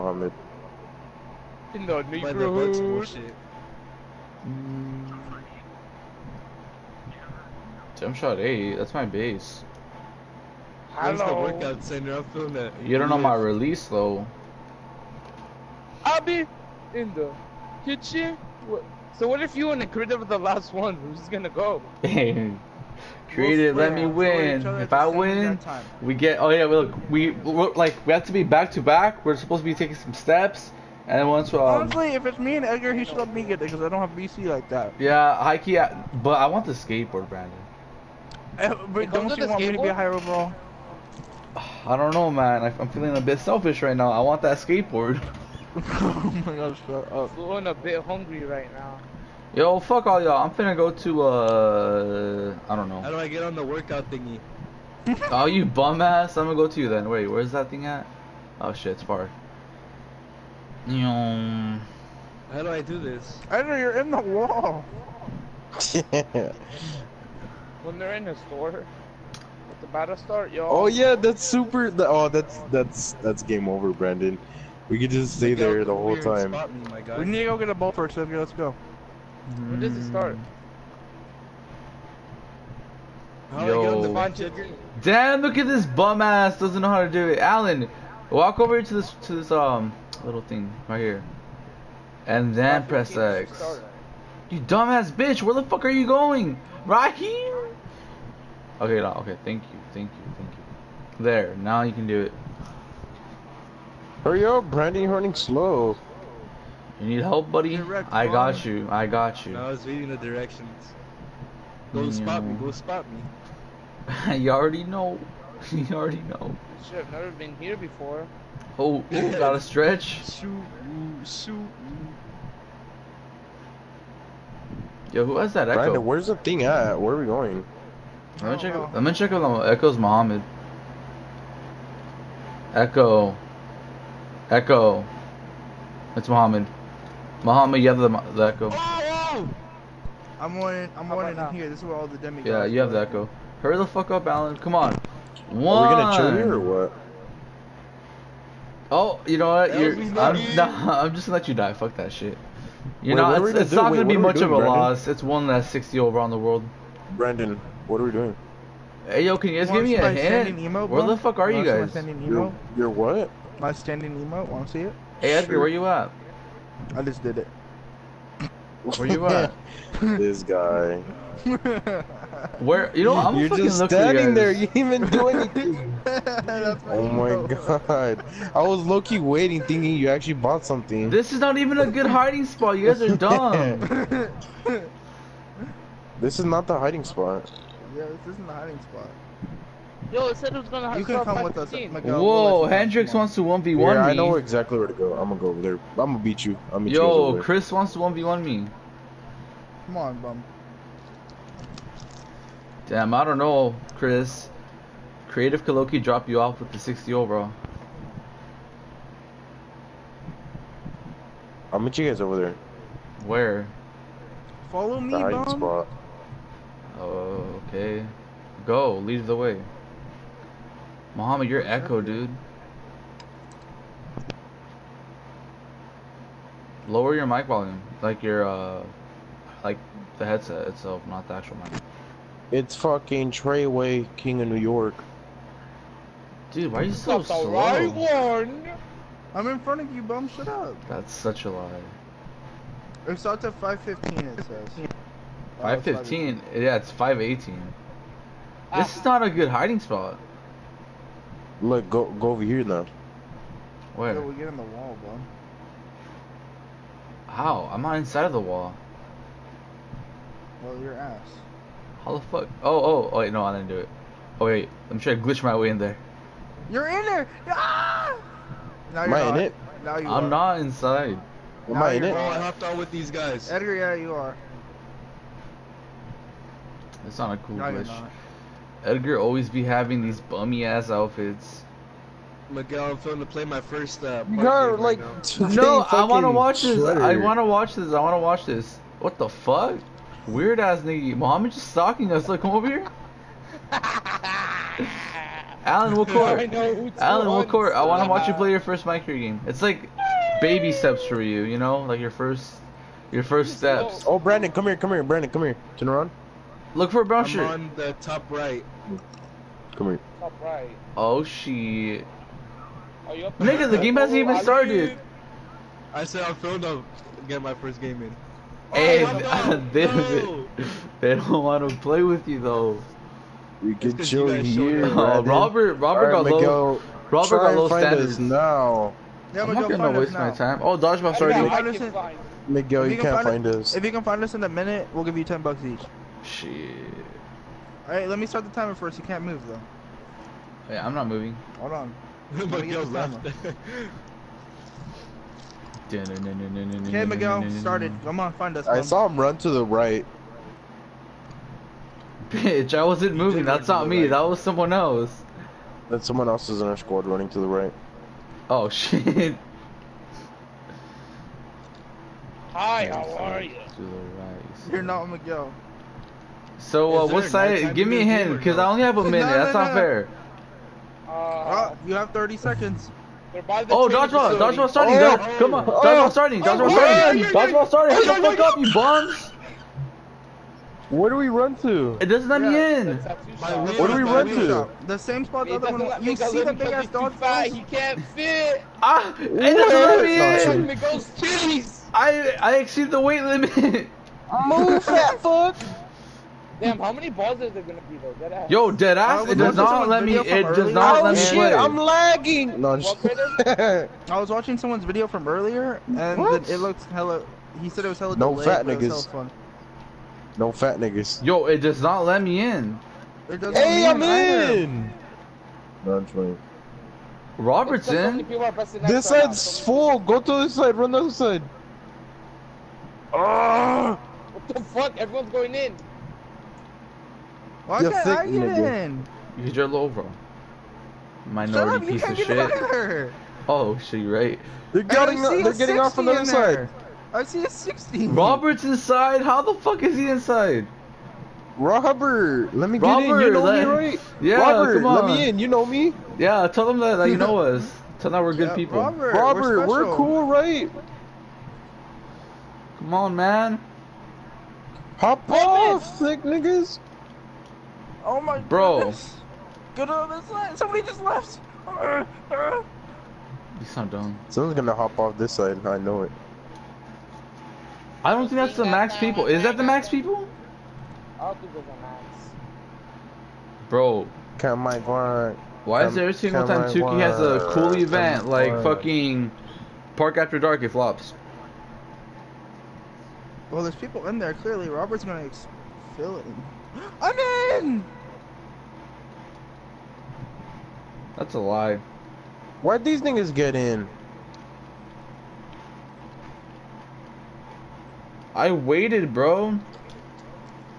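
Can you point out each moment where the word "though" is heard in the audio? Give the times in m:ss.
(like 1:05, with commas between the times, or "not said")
0:13, 5:22, 5:39, 6:37.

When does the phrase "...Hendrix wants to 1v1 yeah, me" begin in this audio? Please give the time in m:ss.
3:12.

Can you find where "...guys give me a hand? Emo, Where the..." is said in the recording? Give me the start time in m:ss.
2:39.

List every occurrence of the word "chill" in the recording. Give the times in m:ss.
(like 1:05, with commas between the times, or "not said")
2:26, 5:24.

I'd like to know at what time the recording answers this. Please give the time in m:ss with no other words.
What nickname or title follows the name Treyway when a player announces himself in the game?
3:54.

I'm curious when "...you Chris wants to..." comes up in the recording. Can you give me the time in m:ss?
3:17.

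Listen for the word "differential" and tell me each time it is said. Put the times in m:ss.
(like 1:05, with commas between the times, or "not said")
not said.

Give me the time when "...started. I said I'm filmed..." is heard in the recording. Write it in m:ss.
5:14.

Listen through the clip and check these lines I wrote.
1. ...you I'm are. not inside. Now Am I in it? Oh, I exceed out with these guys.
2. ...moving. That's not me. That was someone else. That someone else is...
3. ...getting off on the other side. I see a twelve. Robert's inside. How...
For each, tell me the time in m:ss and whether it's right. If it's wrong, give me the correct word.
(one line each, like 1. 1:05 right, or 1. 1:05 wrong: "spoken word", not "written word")
1. 4:29 wrong: "hopped", not "exceed"
2. 5:53 right
3. 7:15 wrong: "sixteen", not "twelve".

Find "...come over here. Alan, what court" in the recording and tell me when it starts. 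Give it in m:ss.
4:52.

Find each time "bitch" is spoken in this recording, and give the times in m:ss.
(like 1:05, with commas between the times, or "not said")
1:35, 5:52.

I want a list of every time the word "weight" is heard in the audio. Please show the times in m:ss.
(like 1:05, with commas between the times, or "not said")
6:32.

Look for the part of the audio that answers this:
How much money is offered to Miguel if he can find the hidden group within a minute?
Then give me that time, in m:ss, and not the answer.
5:35.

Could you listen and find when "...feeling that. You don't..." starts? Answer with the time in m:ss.
0:12.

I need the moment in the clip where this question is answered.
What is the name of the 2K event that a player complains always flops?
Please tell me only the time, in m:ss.
7:59.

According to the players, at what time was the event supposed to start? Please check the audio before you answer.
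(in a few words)
5:15.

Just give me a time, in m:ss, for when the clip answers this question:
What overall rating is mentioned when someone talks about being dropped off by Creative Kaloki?
3:26.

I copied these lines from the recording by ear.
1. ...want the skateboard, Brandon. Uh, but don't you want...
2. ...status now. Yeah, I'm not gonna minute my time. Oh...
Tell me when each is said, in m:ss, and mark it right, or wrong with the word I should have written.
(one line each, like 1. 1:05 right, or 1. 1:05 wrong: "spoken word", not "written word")
1. 0:36 right
2. 5:27 wrong: "waste", not "minute".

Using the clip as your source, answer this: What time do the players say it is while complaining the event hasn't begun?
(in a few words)
5:18.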